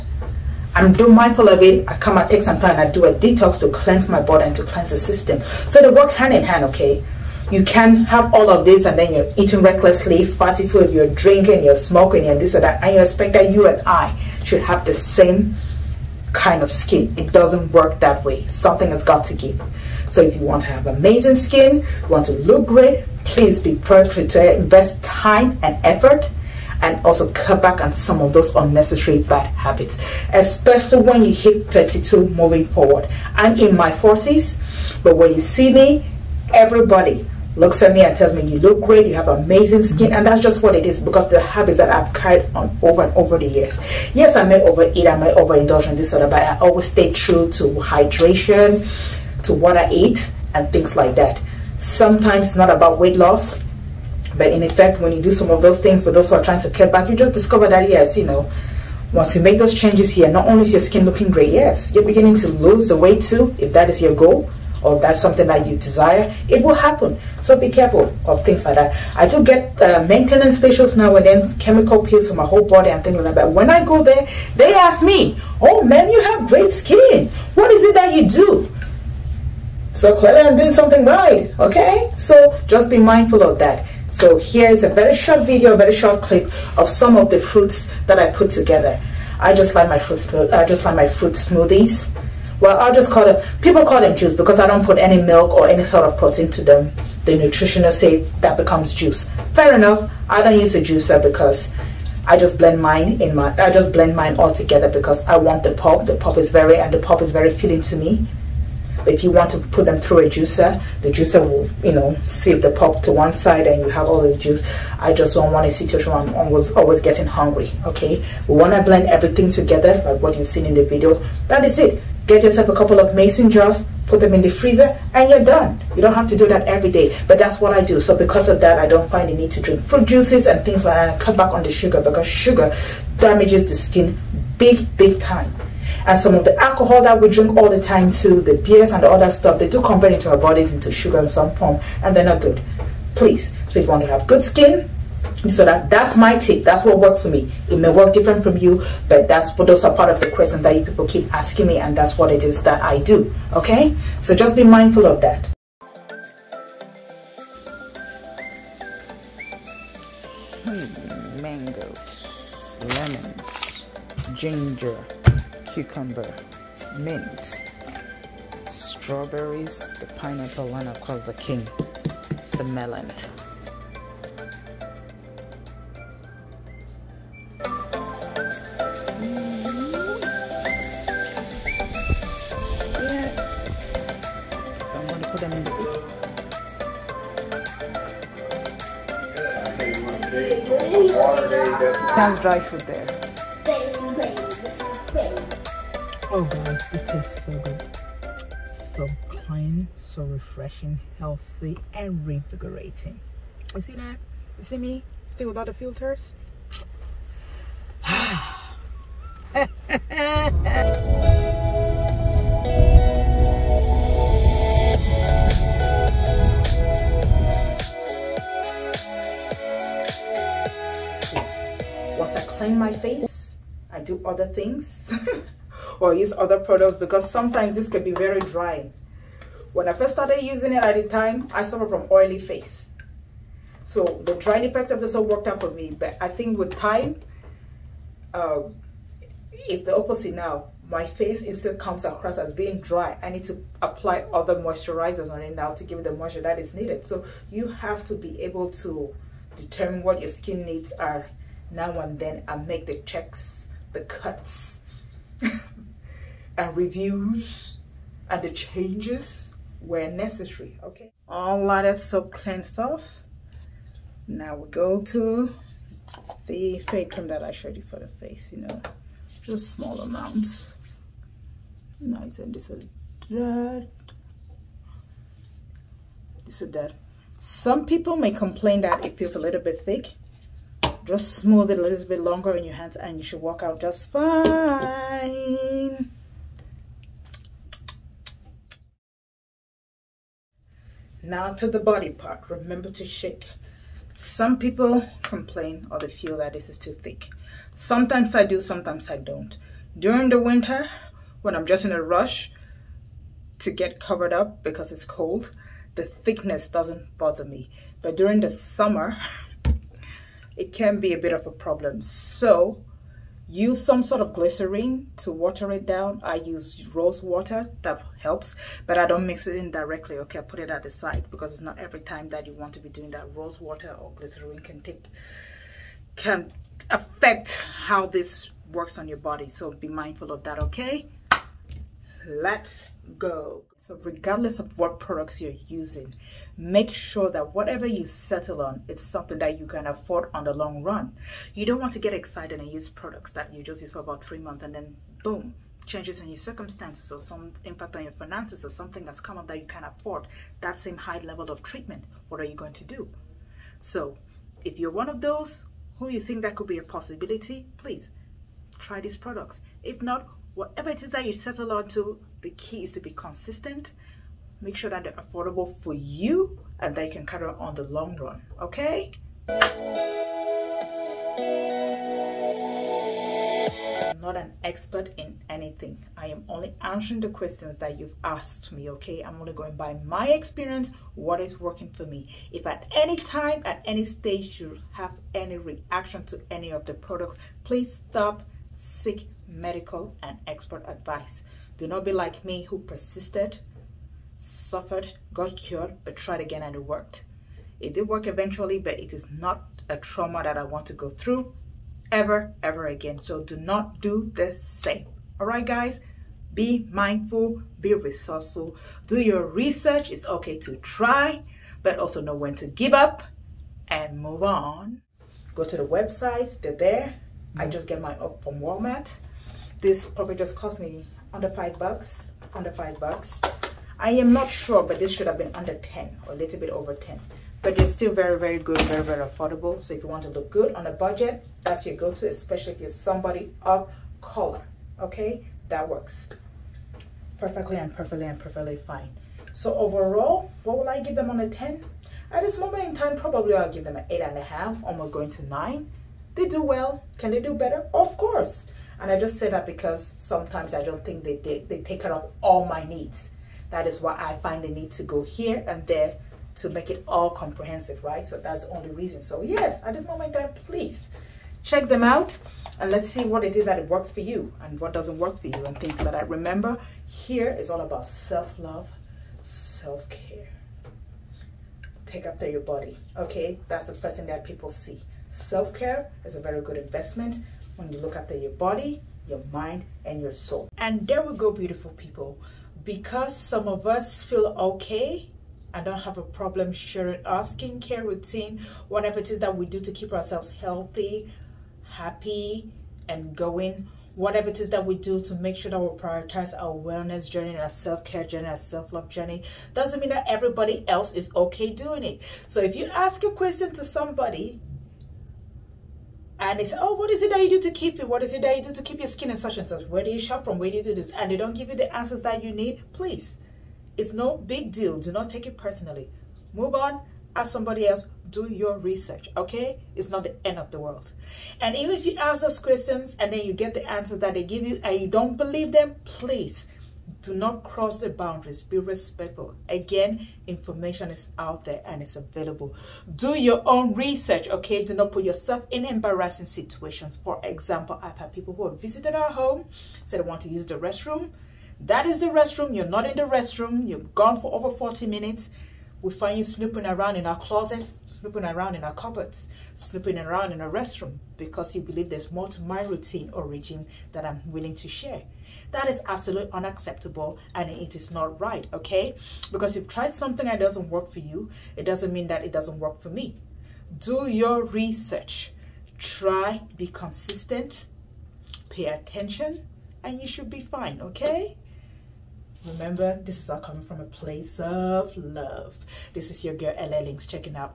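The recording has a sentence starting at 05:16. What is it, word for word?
I use rose water, that helps, but I don't mix it in directly, okay?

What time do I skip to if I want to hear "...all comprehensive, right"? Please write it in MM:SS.
07:37.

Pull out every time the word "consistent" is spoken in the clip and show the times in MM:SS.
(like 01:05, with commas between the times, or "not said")
06:03, 09:26.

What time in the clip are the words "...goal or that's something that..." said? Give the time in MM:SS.
01:04.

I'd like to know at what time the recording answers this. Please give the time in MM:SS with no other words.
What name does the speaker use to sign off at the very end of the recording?
09:36.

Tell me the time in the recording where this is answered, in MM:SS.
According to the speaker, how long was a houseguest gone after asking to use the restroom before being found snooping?
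09:04.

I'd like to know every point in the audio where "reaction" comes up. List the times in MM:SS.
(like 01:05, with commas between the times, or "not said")
06:25.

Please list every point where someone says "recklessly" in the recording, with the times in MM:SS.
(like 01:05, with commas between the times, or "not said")
00:09.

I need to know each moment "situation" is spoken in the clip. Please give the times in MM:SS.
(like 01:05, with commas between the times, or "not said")
01:55, 08:56.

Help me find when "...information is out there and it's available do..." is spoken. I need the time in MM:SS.
08:50.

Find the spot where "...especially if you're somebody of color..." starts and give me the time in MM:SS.
07:12.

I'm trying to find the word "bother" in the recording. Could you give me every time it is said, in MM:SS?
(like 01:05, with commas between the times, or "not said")
05:07.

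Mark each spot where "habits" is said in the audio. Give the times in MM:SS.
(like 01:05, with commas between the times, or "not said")
00:29, 00:41.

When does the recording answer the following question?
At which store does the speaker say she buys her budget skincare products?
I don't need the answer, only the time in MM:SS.
06:58.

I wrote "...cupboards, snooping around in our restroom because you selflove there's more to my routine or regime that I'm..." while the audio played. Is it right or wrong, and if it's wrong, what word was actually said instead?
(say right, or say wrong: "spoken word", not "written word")
wrong: "believe", not "selflove".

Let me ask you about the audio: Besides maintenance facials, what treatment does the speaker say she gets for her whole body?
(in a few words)
chemical peels.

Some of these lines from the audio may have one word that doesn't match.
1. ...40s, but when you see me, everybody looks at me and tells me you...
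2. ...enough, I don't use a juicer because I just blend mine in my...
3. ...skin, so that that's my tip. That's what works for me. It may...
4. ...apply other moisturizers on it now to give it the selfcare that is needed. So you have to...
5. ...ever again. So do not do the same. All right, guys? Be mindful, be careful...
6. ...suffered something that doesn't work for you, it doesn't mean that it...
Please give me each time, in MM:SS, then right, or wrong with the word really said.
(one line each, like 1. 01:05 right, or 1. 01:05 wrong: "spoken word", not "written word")
1. 00:33 right
2. 01:39 right
3. 02:24 right
4. 04:03 wrong: "moisture", not "selfcare"
5. 06:42 wrong: "resourceful", not "careful"
6. 09:19 wrong: "tried", not "suffered".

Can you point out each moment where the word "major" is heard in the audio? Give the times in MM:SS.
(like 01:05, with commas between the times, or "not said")
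not said.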